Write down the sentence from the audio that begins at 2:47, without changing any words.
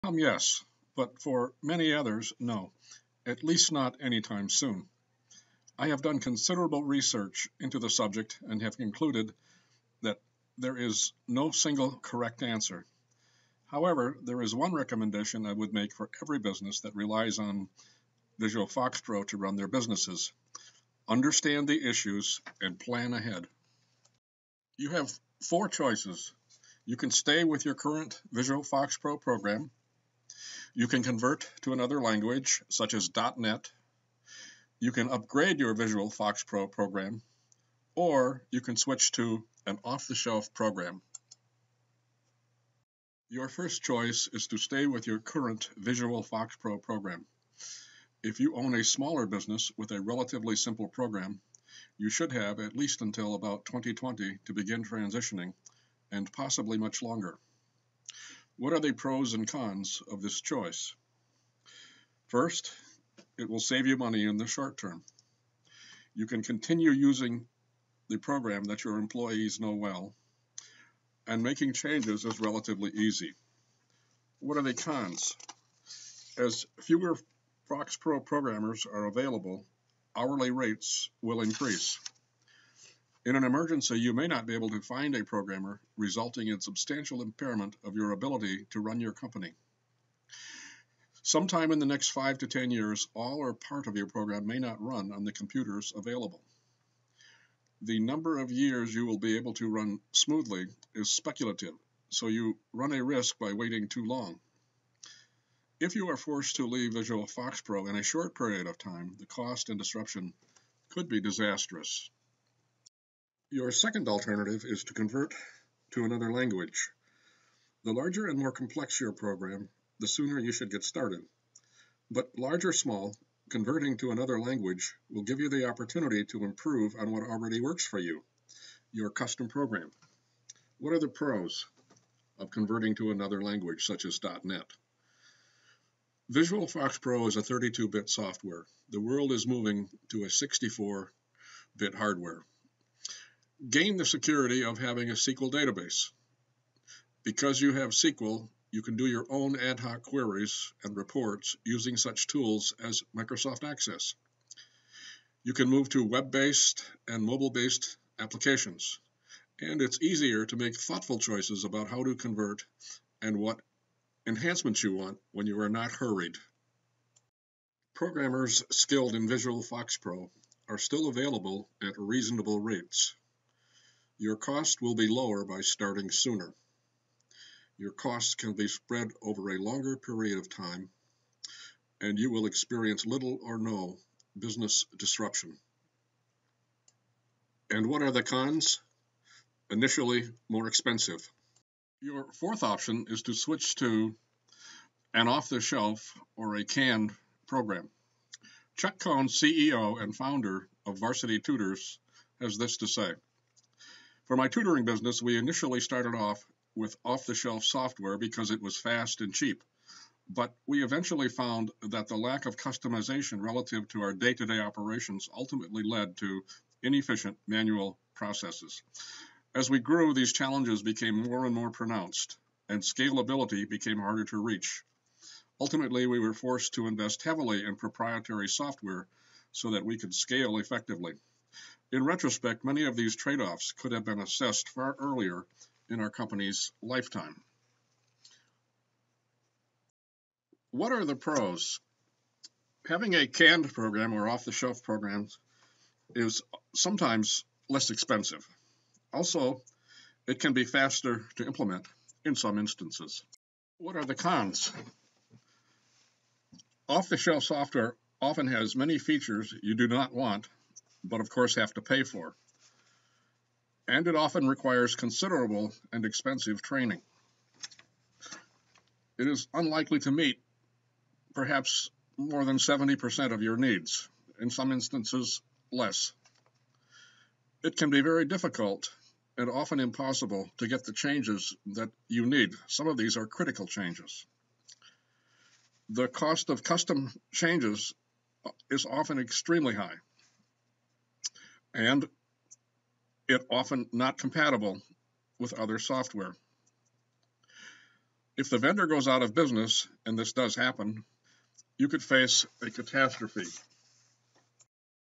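Programmers skilled in Visual FoxPro are still available at reasonable rates.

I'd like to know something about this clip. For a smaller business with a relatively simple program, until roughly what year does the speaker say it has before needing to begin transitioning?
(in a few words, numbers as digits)
2020.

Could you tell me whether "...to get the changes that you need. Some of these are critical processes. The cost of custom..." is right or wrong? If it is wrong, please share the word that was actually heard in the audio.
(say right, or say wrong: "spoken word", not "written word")
wrong: "changes", not "processes".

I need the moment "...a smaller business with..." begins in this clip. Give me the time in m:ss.
0:48.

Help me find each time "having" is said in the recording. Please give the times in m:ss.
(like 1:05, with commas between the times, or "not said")
2:24, 4:02.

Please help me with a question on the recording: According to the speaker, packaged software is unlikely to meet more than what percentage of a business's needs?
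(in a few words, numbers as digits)
70%.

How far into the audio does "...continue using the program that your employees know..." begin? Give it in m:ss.
1:06.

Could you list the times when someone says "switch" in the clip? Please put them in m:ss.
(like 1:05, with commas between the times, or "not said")
0:38, 3:13.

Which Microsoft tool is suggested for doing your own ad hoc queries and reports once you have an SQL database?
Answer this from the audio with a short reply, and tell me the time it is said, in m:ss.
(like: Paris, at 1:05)
Microsoft Access, at 2:33.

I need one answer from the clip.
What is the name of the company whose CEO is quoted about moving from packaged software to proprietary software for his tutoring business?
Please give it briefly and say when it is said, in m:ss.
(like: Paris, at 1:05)
Varsity Tutors, at 3:20.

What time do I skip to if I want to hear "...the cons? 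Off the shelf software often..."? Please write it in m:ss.
4:14.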